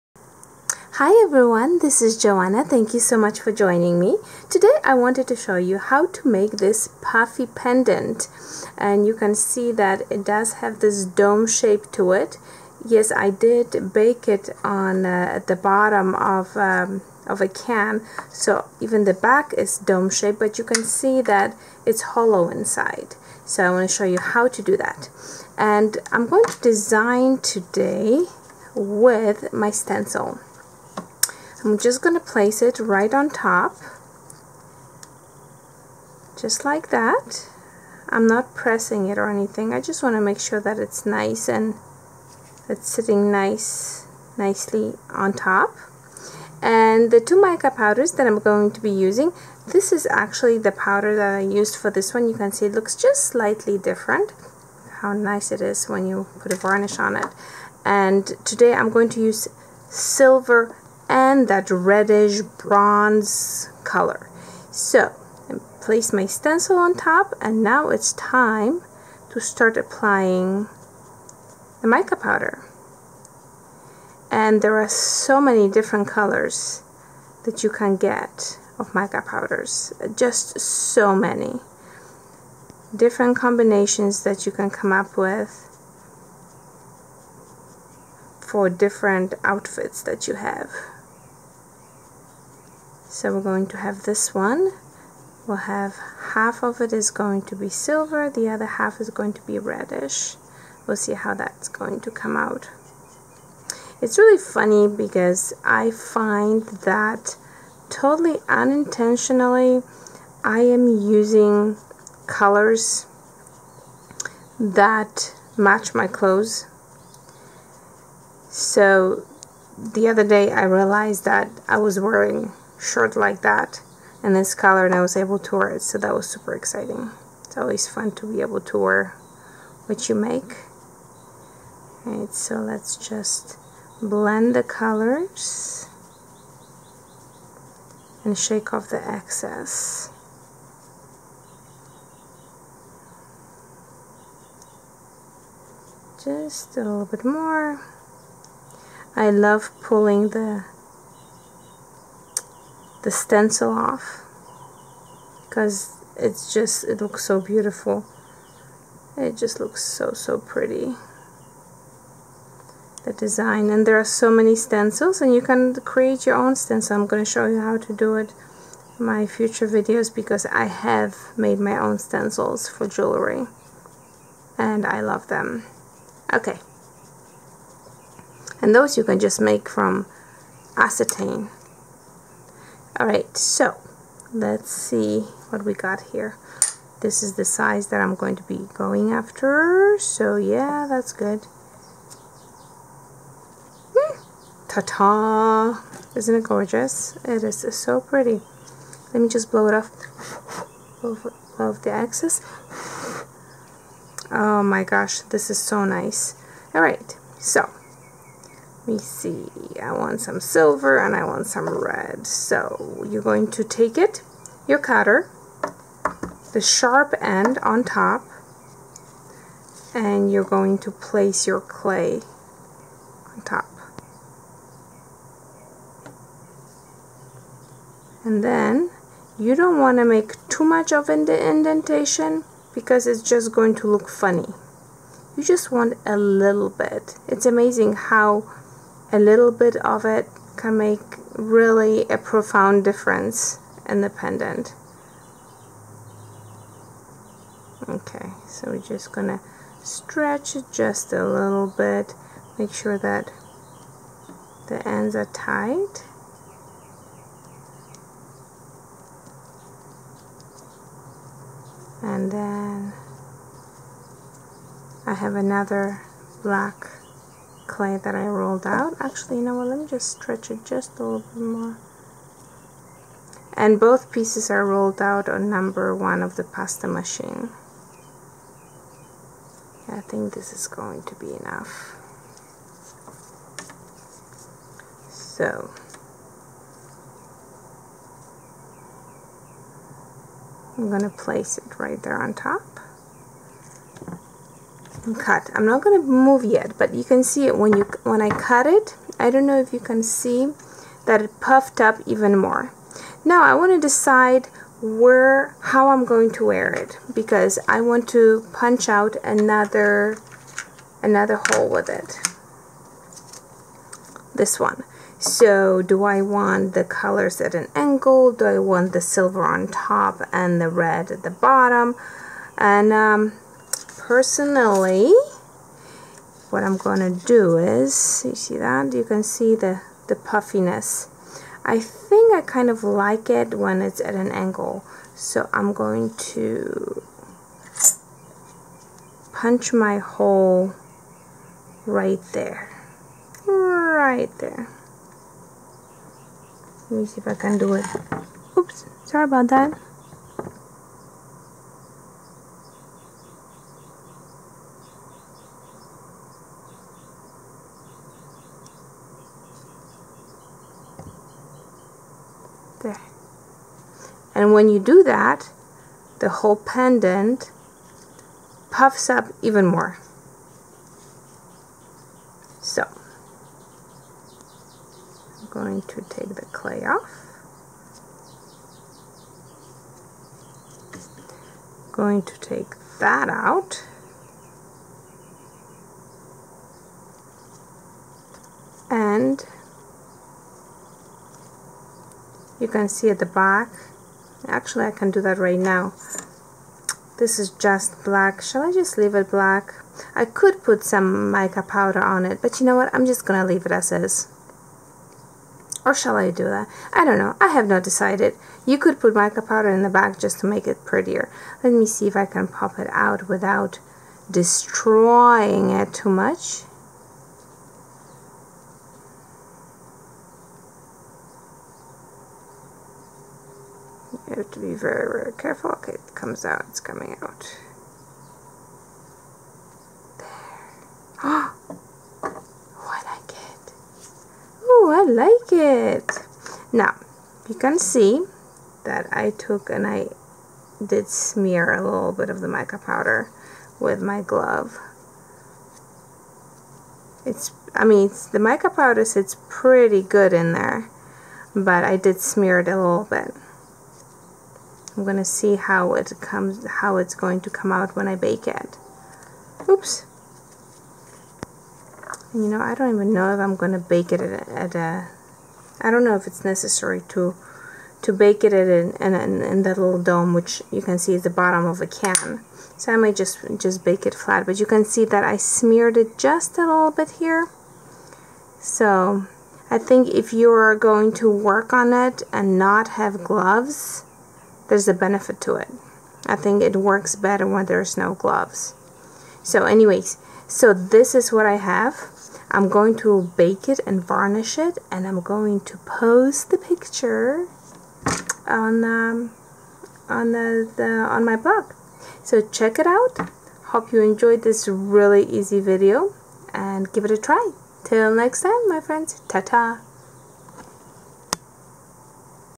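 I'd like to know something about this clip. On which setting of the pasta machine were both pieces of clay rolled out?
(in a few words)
number one.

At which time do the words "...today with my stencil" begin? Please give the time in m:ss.
0:27.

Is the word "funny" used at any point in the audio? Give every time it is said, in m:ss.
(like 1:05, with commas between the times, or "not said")
1:44, 3:54.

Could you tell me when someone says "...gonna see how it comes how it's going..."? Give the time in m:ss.
7:35.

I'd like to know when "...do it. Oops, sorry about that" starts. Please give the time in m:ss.
5:47.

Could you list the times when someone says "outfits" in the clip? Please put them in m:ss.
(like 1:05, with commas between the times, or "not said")
1:29.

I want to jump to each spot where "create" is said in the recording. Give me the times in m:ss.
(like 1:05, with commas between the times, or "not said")
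2:45.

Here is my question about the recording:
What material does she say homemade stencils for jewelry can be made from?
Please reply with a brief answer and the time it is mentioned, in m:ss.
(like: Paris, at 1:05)
acetate, at 3:00.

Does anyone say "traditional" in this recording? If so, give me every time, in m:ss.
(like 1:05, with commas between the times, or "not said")
not said.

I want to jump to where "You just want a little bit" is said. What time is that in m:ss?
3:55.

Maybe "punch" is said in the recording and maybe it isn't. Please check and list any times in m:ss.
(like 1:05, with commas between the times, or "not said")
5:08, 5:39.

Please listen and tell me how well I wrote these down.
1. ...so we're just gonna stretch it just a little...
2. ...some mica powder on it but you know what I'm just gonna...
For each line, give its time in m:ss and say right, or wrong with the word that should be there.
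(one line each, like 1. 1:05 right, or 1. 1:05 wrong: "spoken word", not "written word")
1. 4:08 right
2. 6:40 right.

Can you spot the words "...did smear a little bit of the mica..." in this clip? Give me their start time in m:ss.
7:20.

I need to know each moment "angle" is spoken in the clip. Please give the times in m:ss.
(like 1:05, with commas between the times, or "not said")
5:17, 5:34.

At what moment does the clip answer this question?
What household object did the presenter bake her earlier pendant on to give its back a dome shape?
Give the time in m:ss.
0:15.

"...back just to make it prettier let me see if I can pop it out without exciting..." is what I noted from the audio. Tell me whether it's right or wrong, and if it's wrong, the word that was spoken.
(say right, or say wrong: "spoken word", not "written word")
wrong: "destroying", not "exciting".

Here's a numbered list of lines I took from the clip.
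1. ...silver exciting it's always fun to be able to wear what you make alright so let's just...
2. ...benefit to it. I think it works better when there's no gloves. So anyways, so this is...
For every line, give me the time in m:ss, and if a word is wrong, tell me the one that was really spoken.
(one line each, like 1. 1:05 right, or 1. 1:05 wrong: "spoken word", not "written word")
1. 2:06 wrong: "super", not "silver"
2. 8:04 right.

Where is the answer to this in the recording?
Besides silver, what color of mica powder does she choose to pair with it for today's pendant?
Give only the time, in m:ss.
1:01.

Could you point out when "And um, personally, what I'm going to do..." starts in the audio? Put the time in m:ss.
5:22.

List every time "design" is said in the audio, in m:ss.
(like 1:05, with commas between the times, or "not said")
0:26, 2:43.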